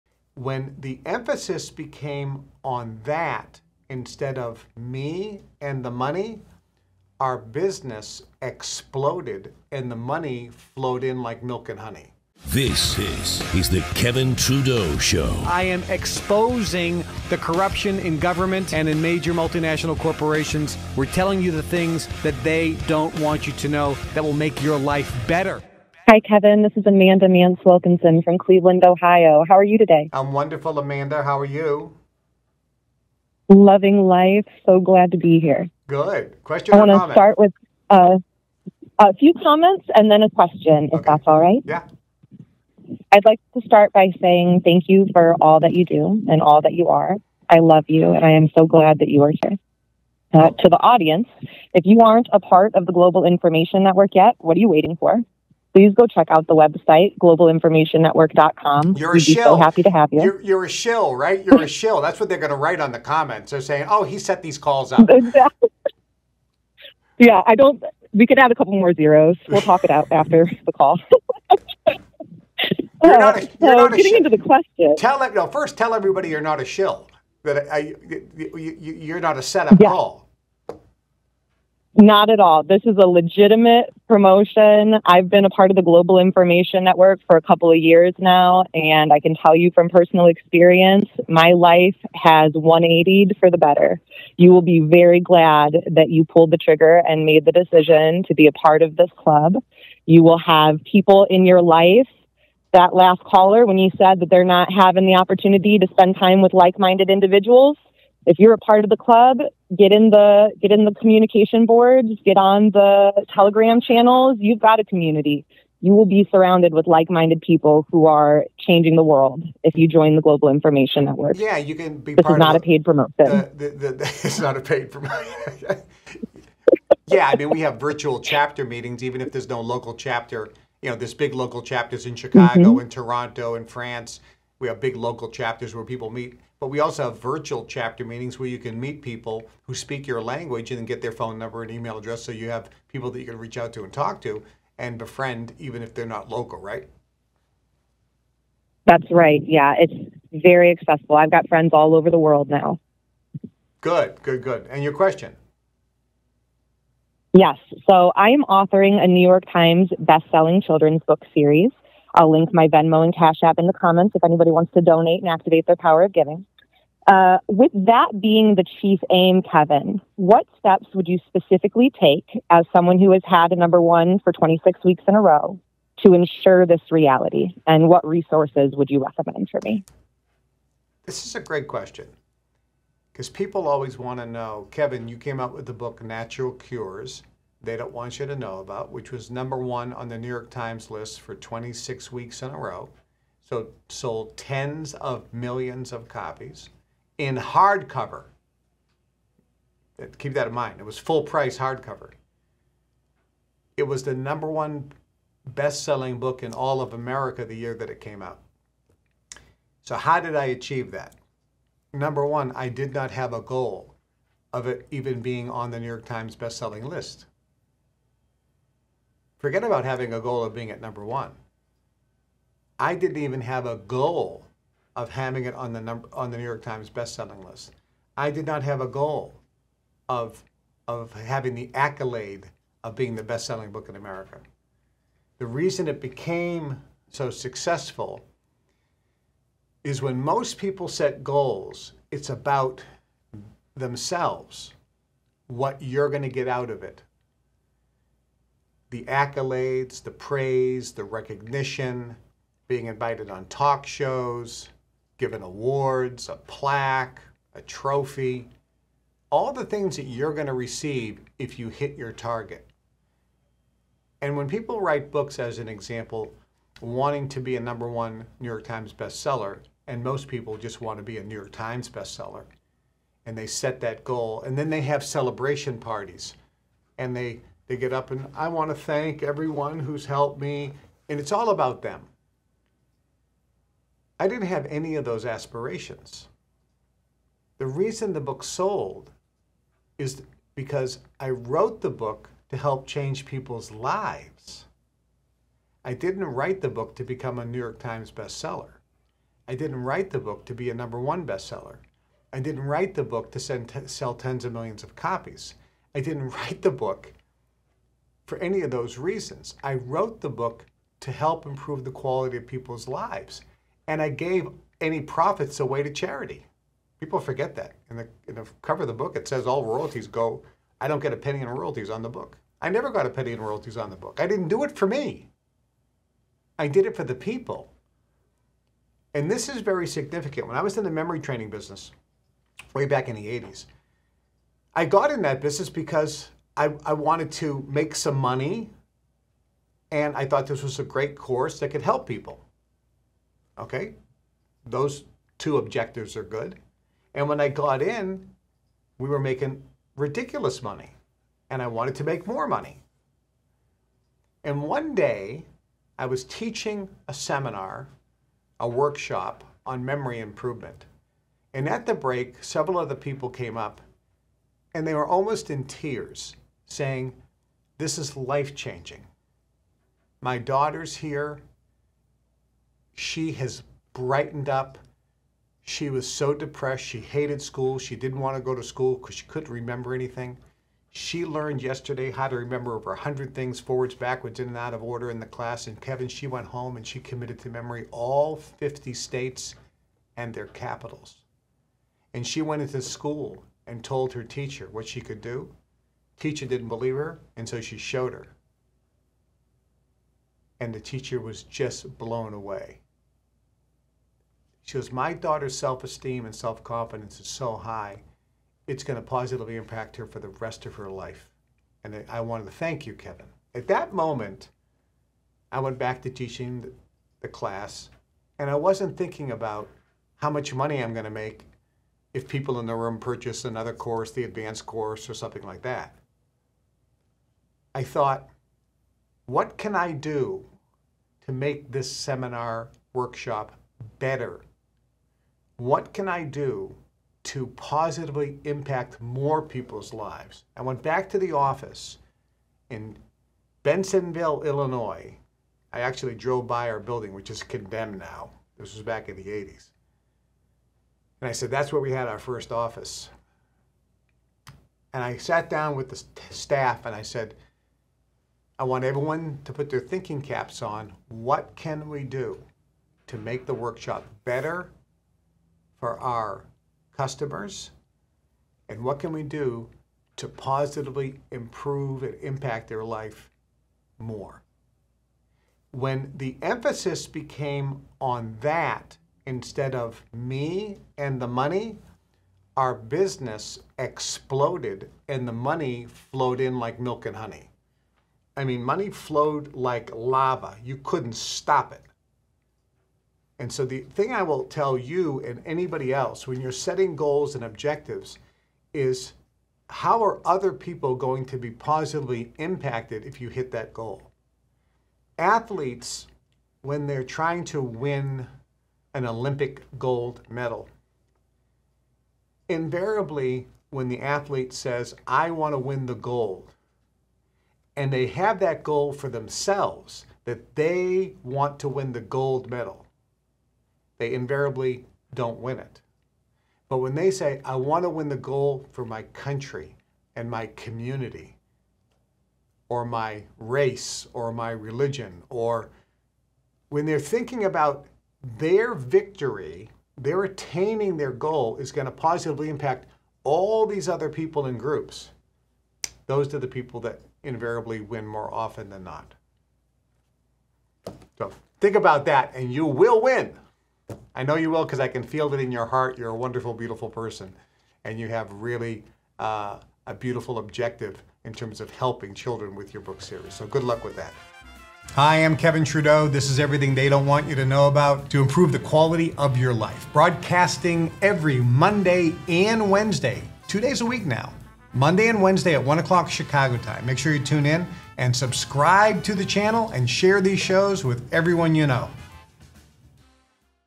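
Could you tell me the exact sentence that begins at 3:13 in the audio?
So sold tens of millions of copies in hardcover.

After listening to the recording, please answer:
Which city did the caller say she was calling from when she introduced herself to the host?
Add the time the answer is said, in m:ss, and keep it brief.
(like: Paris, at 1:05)
Cleveland, Ohio, at 0:28.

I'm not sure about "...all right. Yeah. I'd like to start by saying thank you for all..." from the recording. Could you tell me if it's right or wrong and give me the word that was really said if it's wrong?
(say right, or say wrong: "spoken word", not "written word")
right.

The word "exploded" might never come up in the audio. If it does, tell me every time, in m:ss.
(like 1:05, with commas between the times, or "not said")
0:08, 8:03.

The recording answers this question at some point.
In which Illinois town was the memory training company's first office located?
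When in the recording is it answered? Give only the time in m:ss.
7:23.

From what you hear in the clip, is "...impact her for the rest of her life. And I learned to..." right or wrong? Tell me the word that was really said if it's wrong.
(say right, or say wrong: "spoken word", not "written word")
wrong: "wanted", not "learned".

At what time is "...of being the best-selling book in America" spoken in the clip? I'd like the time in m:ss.
3:52.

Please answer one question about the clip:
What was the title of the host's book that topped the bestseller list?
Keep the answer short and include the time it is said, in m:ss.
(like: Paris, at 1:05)
Natural Cures They Don't Want You to Know About, at 3:06.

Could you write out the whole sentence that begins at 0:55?
please go check out the website, globalinformationnetwork.com.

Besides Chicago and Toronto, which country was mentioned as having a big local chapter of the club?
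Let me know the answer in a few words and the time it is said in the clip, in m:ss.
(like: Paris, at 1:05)
France, at 2:13.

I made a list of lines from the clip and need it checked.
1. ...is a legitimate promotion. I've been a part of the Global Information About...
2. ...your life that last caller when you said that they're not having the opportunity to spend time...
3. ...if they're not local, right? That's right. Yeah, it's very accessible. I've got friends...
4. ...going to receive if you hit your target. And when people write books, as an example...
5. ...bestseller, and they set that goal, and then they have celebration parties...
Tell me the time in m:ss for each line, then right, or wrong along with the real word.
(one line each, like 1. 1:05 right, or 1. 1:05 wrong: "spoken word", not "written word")
1. 1:22 wrong: "Network", not "About"
2. 1:41 right
3. 2:25 right
4. 4:20 right
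5. 4:31 right.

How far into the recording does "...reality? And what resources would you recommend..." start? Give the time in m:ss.
2:56.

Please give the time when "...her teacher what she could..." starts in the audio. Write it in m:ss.
6:34.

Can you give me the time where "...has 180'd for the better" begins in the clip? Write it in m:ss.
1:32.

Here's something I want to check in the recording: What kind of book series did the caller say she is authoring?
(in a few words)
Children's book series.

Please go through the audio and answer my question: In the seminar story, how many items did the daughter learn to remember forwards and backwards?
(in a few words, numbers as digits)
Over 100.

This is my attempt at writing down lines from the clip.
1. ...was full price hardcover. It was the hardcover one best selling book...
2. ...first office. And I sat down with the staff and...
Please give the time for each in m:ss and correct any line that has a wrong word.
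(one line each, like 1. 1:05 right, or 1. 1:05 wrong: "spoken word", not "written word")
1. 3:20 wrong: "number", not "hardcover"
2. 7:32 right.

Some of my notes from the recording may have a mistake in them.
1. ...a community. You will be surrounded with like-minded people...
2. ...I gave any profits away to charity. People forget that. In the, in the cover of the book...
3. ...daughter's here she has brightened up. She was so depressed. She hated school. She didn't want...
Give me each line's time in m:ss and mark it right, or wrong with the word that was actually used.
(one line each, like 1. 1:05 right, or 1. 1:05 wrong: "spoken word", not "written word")
1. 1:54 right
2. 5:14 right
3. 6:10 right.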